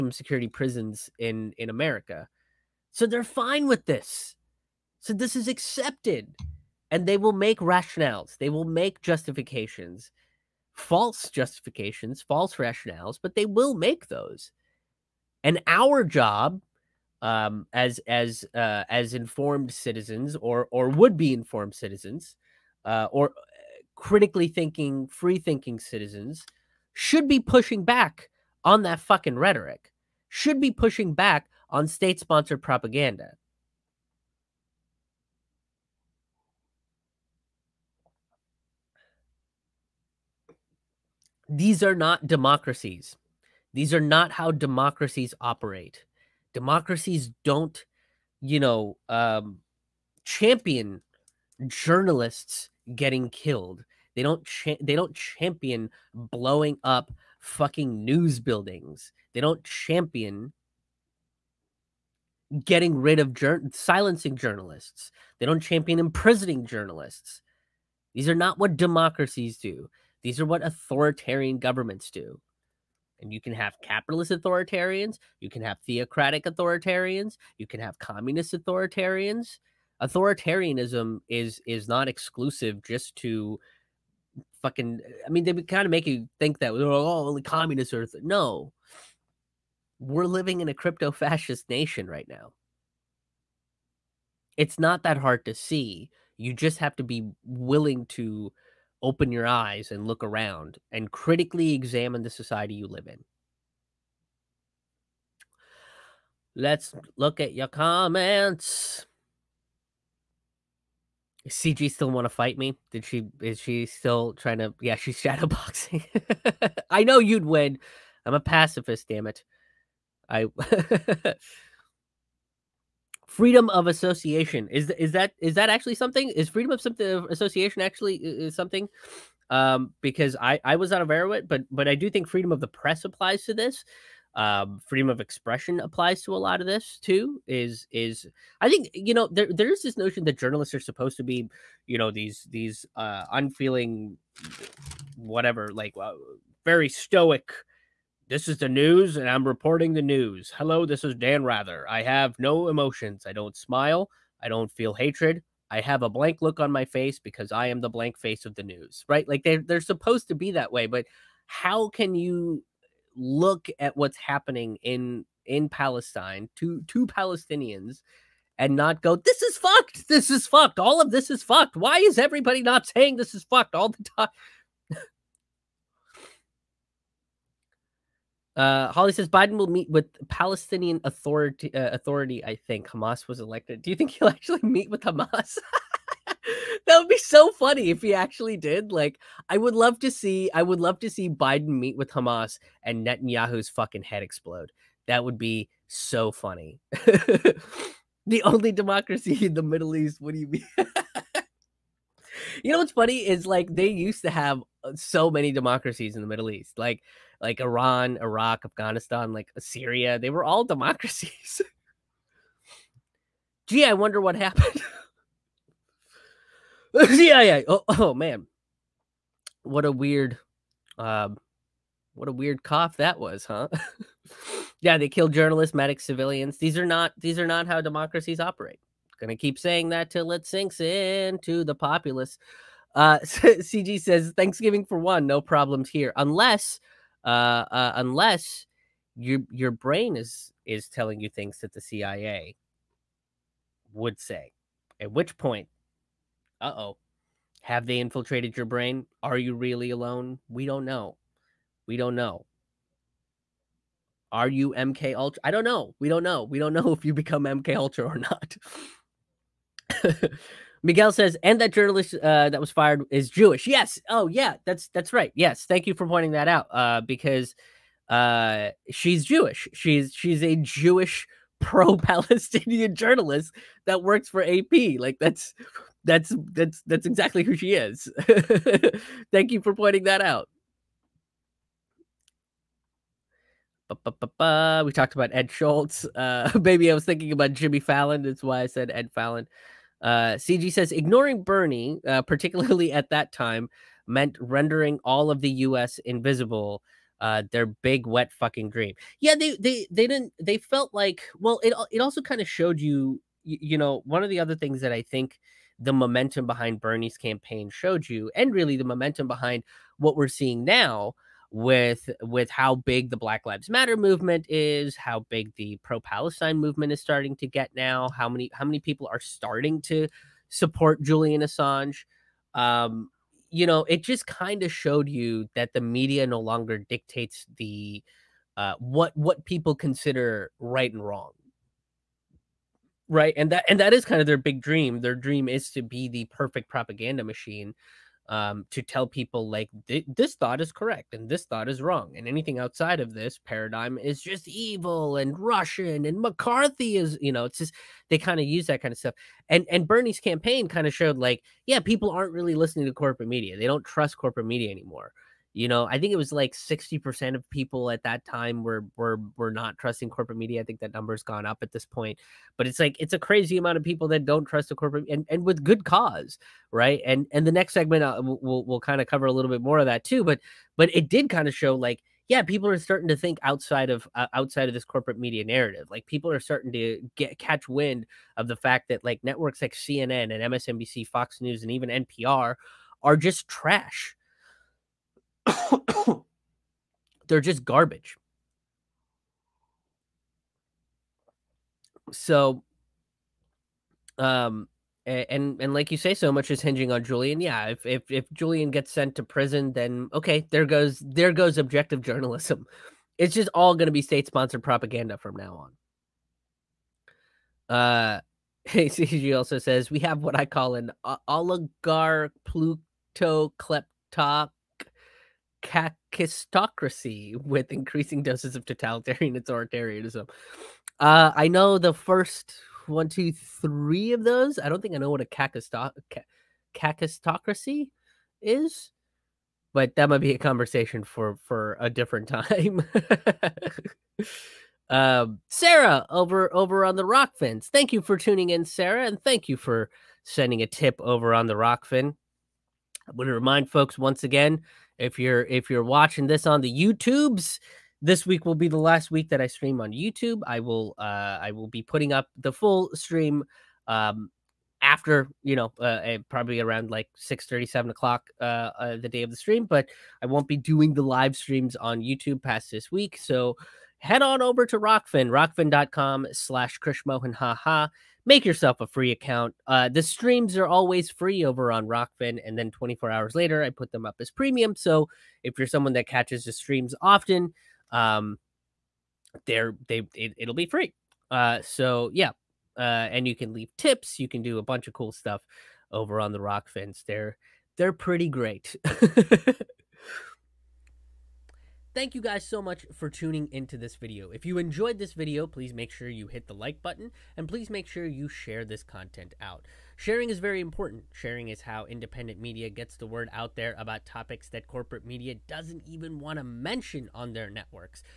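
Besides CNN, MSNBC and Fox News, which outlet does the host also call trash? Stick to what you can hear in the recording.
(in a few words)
NPR.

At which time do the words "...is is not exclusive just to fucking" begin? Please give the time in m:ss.
1:21.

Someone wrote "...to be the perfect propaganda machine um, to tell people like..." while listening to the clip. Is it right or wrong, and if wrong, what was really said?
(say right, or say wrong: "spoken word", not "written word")
right.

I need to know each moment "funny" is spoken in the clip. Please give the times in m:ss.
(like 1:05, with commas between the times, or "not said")
3:07, 3:16, 3:22.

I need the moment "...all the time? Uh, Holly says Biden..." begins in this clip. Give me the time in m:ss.
2:53.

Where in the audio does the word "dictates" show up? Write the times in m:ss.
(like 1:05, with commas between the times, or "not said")
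5:26.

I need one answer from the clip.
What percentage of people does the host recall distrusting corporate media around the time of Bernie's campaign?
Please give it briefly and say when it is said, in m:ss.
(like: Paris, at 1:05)
60%, at 5:56.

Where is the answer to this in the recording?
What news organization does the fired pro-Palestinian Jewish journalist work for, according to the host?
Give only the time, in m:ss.
4:34.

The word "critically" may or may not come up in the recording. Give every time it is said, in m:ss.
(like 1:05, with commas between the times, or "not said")
0:23, 1:41.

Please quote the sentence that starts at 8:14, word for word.
If you enjoyed this video, please make sure you hit the like button and please make sure you share this content out.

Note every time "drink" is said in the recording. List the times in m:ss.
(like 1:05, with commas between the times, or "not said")
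not said.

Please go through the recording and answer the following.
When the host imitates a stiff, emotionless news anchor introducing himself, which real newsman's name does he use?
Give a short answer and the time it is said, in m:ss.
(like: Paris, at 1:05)
Dan Rather, at 2:31.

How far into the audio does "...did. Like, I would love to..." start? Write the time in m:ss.
3:08.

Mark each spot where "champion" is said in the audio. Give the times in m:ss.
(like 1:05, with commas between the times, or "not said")
0:50, 0:55, 0:59, 1:05.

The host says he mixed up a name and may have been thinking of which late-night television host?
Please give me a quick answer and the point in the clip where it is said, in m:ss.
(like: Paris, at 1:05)
Jimmy Fallon, at 4:47.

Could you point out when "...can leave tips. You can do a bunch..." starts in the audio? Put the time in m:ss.
8:03.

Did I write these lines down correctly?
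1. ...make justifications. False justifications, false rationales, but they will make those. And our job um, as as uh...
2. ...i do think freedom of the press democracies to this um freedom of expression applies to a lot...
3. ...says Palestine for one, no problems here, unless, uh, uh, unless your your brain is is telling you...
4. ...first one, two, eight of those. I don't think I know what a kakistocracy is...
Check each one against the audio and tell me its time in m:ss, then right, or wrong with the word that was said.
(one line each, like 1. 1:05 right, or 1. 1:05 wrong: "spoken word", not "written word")
1. 0:08 right
2. 2:11 wrong: "applies", not "democracies"
3. 3:54 wrong: "Thanksgiving", not "Palestine"
4. 7:01 wrong: "three", not "eight".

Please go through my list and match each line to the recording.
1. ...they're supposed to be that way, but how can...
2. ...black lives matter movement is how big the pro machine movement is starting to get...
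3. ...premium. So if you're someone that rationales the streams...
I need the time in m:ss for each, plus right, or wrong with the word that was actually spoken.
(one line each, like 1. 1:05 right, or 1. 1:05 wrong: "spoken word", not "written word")
1. 2:39 right
2. 5:13 wrong: "palestine", not "machine"
3. 7:54 wrong: "catches", not "rationales".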